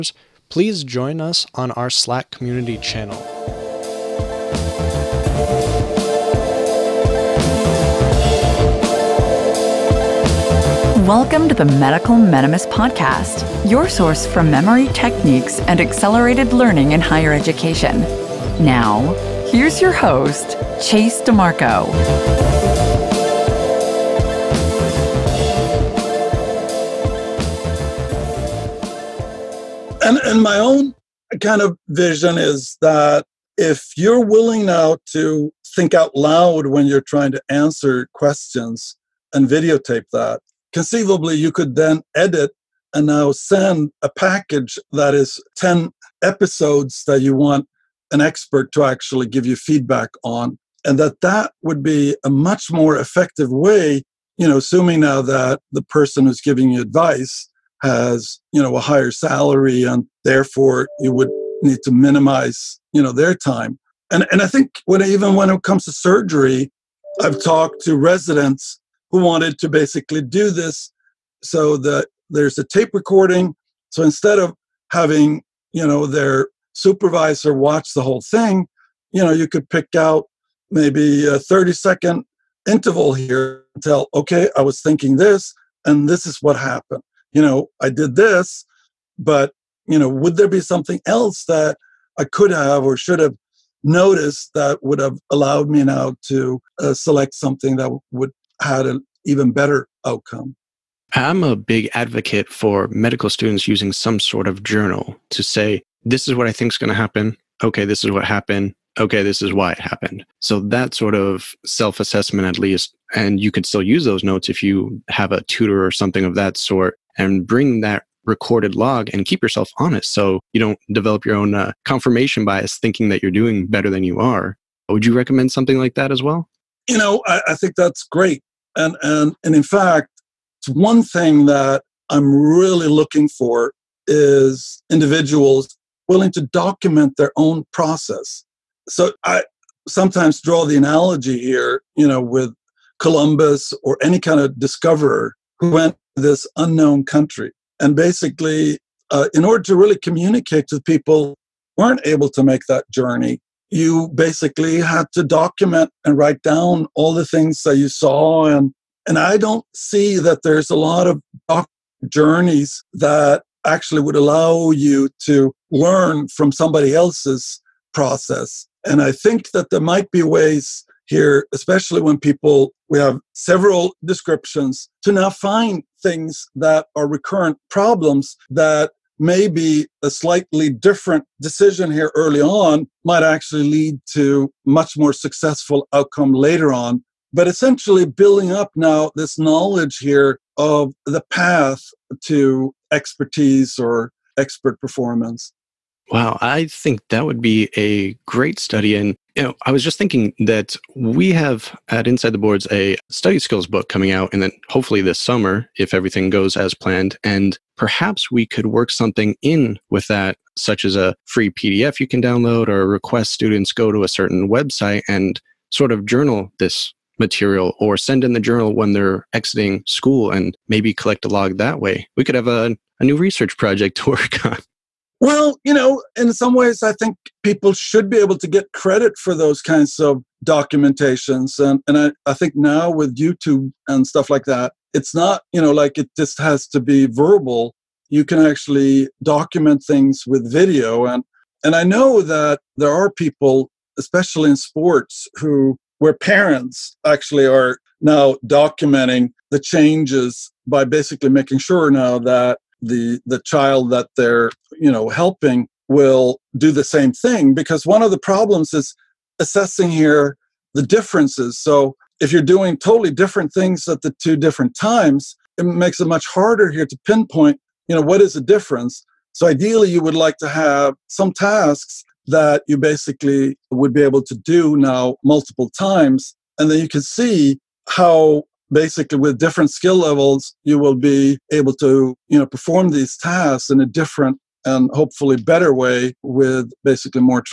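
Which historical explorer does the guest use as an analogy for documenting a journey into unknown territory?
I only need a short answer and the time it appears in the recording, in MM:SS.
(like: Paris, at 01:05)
Columbus, at 02:22.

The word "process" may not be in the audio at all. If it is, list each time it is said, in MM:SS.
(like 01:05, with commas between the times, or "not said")
02:17, 02:47.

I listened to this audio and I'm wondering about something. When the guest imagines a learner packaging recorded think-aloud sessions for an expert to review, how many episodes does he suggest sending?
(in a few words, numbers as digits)
10.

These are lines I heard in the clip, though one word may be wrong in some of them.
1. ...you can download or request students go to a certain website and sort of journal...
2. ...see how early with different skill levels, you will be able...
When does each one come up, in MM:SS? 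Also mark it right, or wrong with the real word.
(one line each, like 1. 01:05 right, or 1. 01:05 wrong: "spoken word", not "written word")
1. 03:31 right
2. 04:37 wrong: "basically", not "early".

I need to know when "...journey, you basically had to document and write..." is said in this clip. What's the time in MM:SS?
02:32.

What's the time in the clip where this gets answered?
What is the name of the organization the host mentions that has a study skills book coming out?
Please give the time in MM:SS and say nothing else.
03:22.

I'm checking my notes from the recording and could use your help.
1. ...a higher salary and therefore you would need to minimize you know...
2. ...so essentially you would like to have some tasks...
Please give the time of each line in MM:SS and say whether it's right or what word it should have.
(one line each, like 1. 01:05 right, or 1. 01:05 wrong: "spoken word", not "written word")
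1. 00:58 right
2. 04:29 wrong: "ideally", not "essentially".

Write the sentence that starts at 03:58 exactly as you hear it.
You can actually document things with video.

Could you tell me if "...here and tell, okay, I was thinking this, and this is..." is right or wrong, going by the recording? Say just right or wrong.
right.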